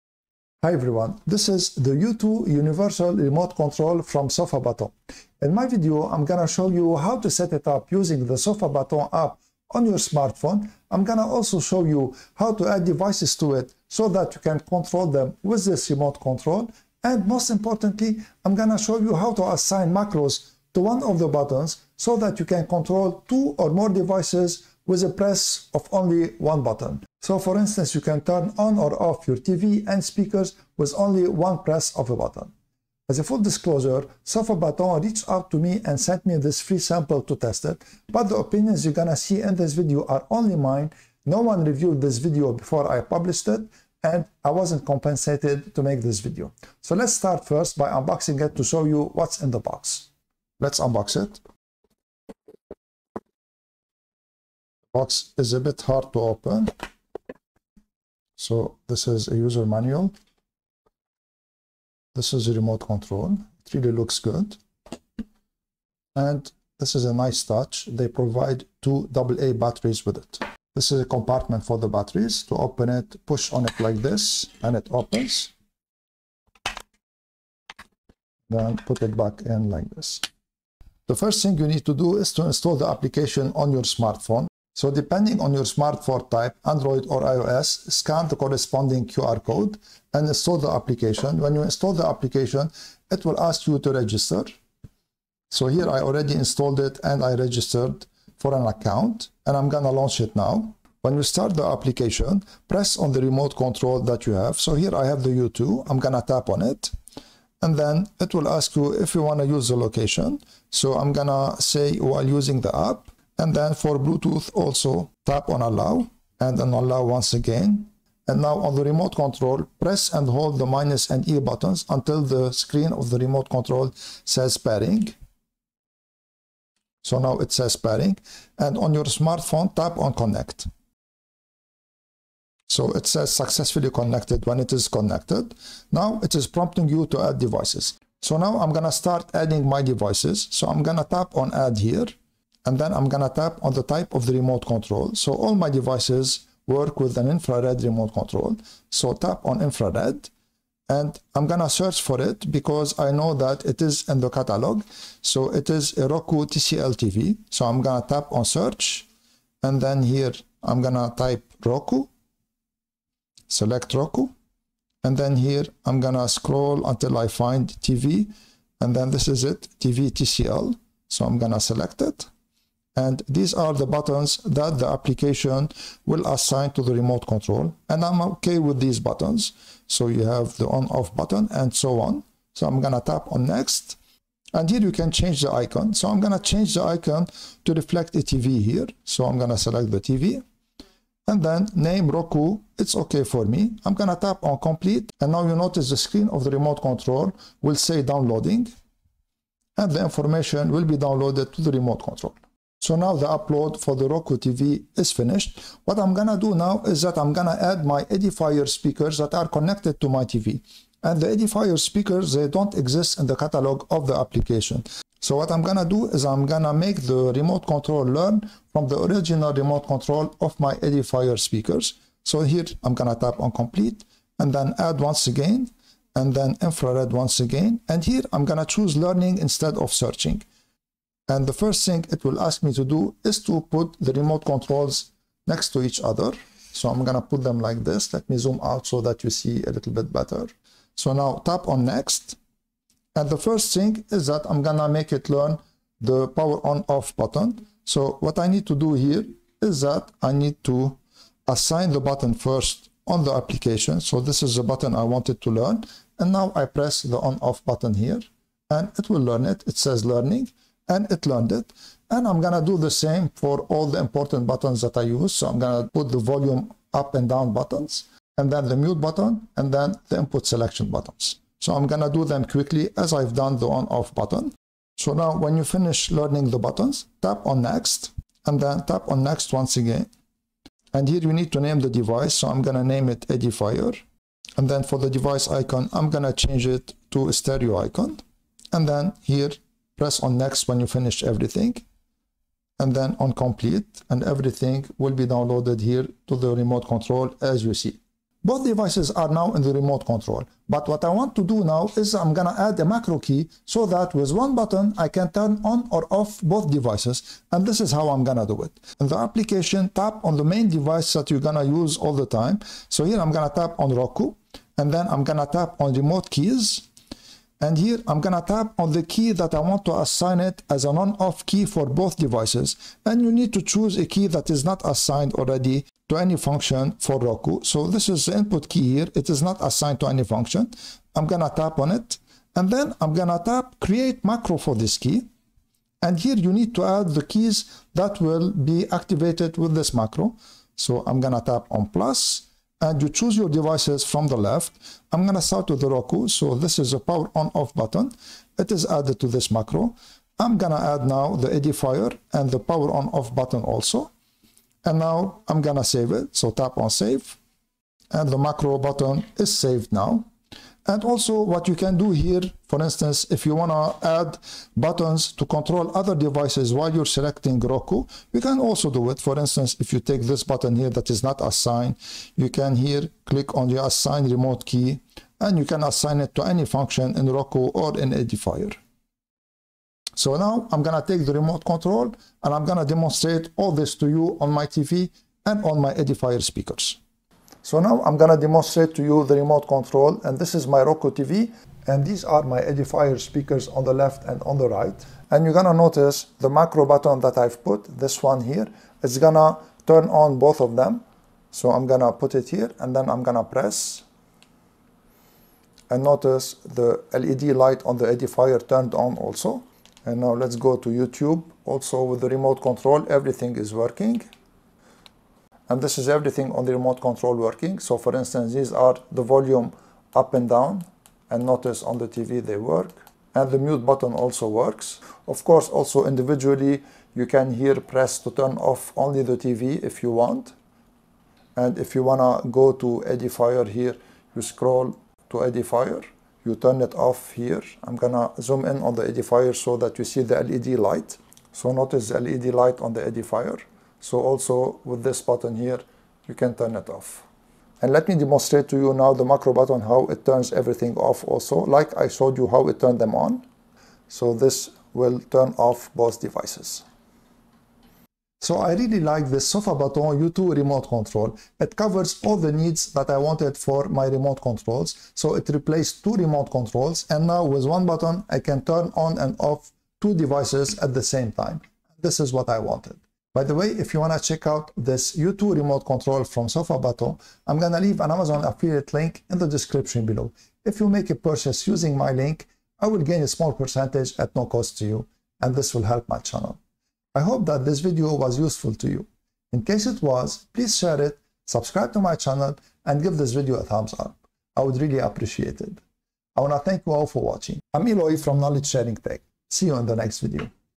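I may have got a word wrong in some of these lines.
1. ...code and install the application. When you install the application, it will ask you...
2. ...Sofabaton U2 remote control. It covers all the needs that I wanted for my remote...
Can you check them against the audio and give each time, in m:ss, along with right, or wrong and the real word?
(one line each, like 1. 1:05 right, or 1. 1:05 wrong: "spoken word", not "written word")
1. 1:29 right
2. 7:39 right.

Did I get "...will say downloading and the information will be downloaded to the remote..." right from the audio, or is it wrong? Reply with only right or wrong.
right.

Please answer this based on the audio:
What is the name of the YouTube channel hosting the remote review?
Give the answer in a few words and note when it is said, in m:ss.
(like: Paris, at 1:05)
Knowledge Sharing Tech, at 8:18.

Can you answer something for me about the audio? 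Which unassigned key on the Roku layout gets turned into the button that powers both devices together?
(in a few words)
Input key.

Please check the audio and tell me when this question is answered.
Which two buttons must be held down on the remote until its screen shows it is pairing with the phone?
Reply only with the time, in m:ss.
2:00.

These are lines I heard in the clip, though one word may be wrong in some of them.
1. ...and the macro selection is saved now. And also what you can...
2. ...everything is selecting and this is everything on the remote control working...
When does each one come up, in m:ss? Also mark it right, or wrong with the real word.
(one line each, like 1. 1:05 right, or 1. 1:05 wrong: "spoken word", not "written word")
1. 5:58 wrong: "button", not "selection"
2. 6:53 wrong: "working", not "selecting".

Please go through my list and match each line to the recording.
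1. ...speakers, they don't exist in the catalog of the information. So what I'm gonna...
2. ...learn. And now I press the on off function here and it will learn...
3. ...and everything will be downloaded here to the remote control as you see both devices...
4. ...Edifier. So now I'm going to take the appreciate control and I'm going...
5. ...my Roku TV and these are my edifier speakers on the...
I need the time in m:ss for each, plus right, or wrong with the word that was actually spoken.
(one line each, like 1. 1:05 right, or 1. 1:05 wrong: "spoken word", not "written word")
1. 3:31 wrong: "application", not "information"
2. 4:15 wrong: "button", not "function"
3. 4:54 right
4. 6:18 wrong: "remote", not "appreciate"
5. 6:30 right.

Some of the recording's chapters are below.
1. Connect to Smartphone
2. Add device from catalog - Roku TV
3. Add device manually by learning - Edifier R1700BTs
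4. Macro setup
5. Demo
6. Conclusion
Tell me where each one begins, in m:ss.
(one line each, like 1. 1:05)
1. 1:23
2. 2:11
3. 3:25
4. 4:57
5. 5:26
6. 7:37.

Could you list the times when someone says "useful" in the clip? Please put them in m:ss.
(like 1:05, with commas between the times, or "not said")
8:08.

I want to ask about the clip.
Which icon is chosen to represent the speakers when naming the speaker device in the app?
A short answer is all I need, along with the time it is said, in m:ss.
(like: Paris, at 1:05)
Stereo icon, at 4:47.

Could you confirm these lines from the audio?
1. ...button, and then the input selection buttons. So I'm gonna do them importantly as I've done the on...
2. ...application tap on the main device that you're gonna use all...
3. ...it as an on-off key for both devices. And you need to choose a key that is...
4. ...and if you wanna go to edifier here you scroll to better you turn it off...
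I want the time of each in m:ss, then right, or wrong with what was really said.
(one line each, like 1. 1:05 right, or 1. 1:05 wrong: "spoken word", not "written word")
1. 4:29 wrong: "quickly", not "importantly"
2. 5:09 right
3. 5:20 right
4. 7:11 wrong: "edifier", not "better".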